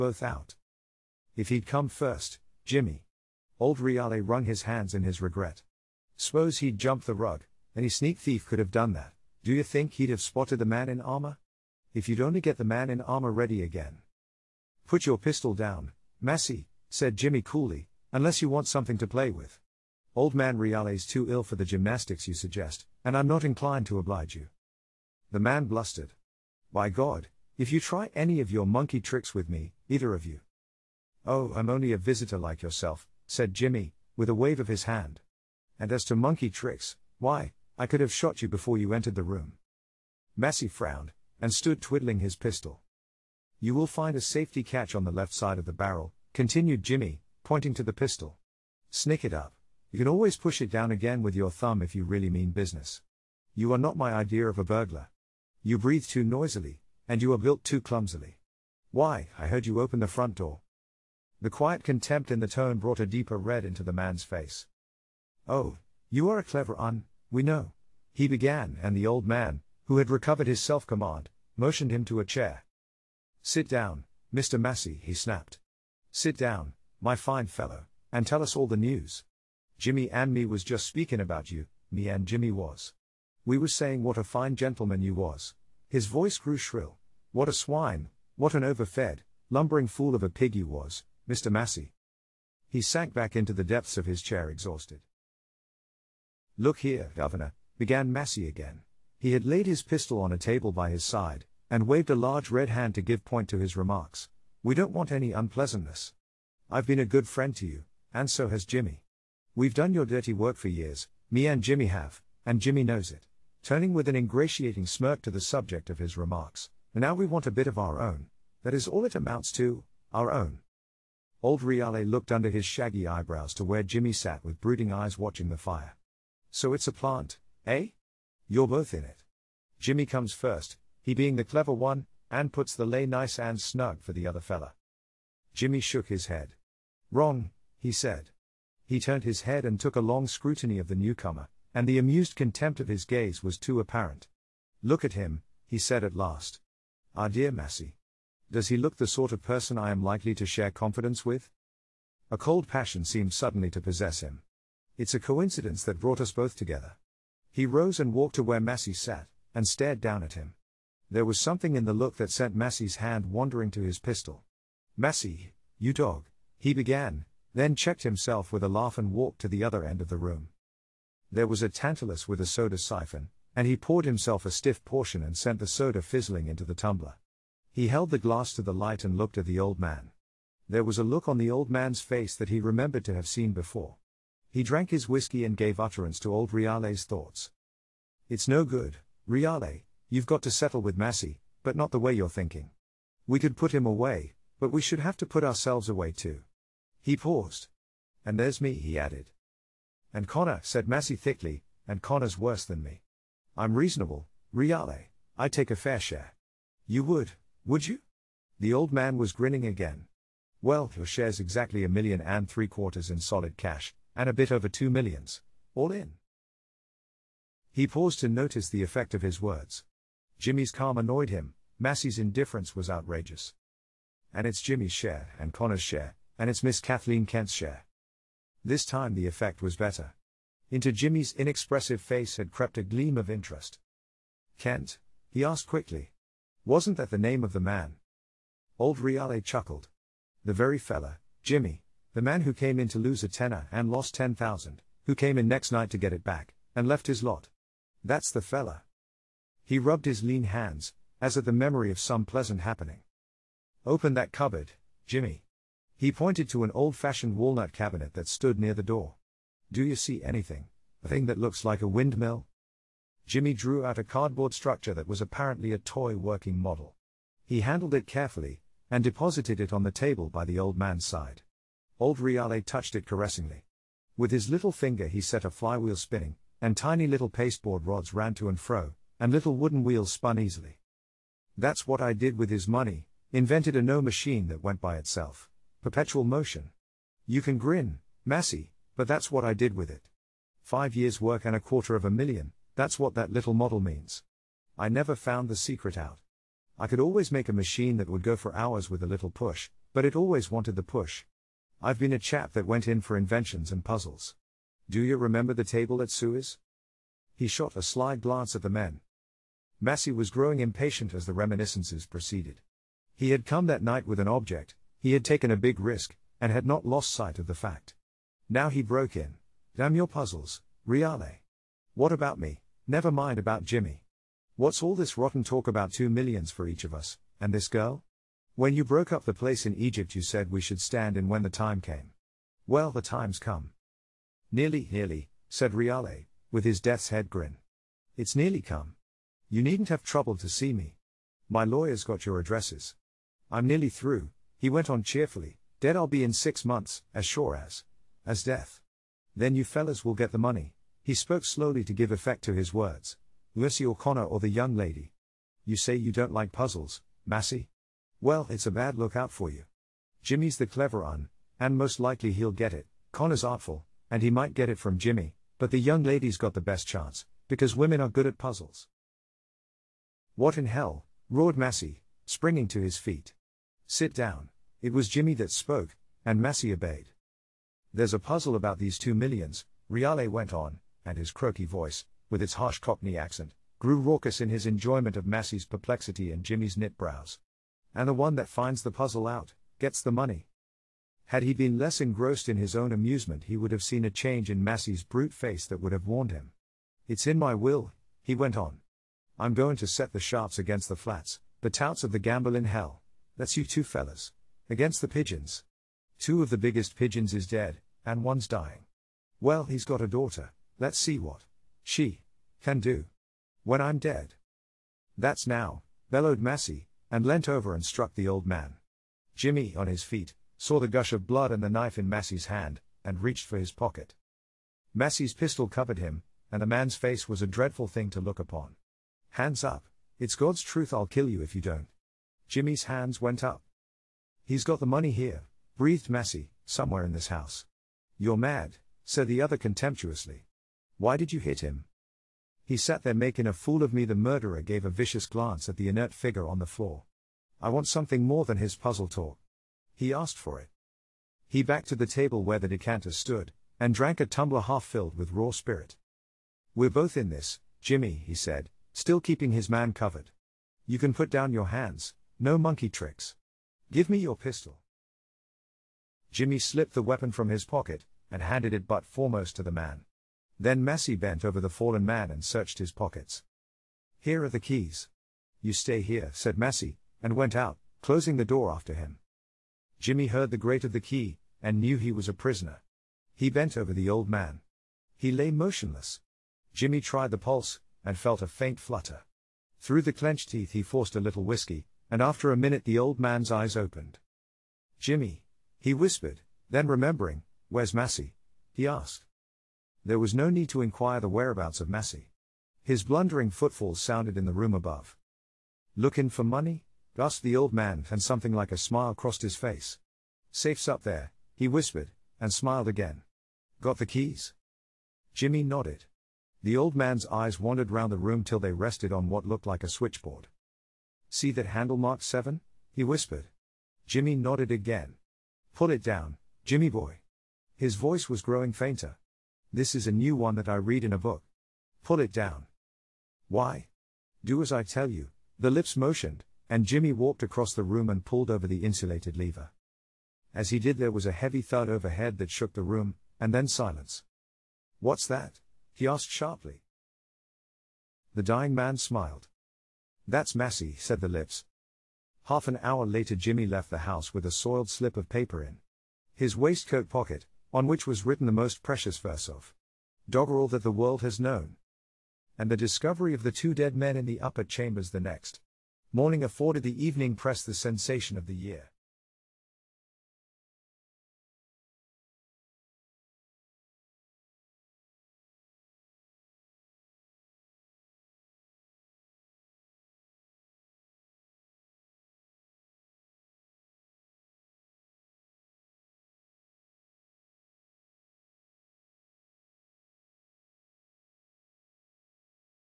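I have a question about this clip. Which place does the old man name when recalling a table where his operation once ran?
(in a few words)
Suez.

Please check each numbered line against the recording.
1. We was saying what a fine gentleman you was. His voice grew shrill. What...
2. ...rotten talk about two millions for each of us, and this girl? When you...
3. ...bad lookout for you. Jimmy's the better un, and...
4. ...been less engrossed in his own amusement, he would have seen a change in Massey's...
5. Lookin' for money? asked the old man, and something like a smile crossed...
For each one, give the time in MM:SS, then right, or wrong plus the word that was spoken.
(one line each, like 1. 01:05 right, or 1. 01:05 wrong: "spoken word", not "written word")
1. 01:23 right
2. 05:25 right
3. 05:58 wrong: "clever", not "better"
4. 06:31 right
5. 08:25 right.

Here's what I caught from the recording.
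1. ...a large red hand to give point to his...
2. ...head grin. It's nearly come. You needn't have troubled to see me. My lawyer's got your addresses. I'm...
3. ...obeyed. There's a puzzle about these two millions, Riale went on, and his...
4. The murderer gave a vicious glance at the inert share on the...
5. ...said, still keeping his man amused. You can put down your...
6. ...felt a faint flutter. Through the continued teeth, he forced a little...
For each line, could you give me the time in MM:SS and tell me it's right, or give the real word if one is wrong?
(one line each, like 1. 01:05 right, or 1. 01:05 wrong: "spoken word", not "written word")
1. 01:42 right
2. 05:37 right
3. 06:16 right
4. 07:24 wrong: "figure", not "share"
5. 07:38 wrong: "covered", not "amused"
6. 08:08 wrong: "clenched", not "continued".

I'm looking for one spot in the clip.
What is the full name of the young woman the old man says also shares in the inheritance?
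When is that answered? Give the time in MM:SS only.
03:46.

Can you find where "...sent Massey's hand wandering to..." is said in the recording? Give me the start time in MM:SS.
02:42.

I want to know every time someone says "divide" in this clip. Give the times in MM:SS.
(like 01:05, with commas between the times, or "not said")
not said.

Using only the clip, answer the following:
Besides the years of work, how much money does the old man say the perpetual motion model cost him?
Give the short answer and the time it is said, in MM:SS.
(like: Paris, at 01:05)
a quarter of a million, at 04:51.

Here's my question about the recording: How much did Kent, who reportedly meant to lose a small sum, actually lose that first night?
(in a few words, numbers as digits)
ten thousand.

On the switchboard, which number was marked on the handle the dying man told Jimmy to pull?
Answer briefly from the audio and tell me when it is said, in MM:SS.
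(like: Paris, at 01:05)
7, at 08:42.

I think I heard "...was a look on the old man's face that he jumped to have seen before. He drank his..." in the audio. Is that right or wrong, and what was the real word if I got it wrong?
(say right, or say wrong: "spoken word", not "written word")
wrong: "remembered", not "jumped".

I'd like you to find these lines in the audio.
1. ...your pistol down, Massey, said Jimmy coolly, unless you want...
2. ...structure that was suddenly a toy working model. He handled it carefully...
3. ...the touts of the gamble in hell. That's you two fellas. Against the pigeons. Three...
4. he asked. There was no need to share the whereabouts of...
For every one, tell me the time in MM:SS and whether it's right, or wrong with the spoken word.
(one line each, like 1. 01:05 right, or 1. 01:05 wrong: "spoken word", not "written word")
1. 00:15 right
2. 04:24 wrong: "apparently", not "suddenly"
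3. 06:41 wrong: "Two", not "Three"
4. 08:18 wrong: "inquire", not "share".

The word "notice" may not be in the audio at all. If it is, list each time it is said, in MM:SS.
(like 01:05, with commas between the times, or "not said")
03:38.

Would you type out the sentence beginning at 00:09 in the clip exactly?
Do you think he'd have spotted the man in armor?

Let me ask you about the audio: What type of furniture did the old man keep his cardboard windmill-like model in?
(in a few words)
walnut cabinet.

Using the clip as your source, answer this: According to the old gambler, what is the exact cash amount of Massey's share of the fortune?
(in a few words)
a million and three quarters.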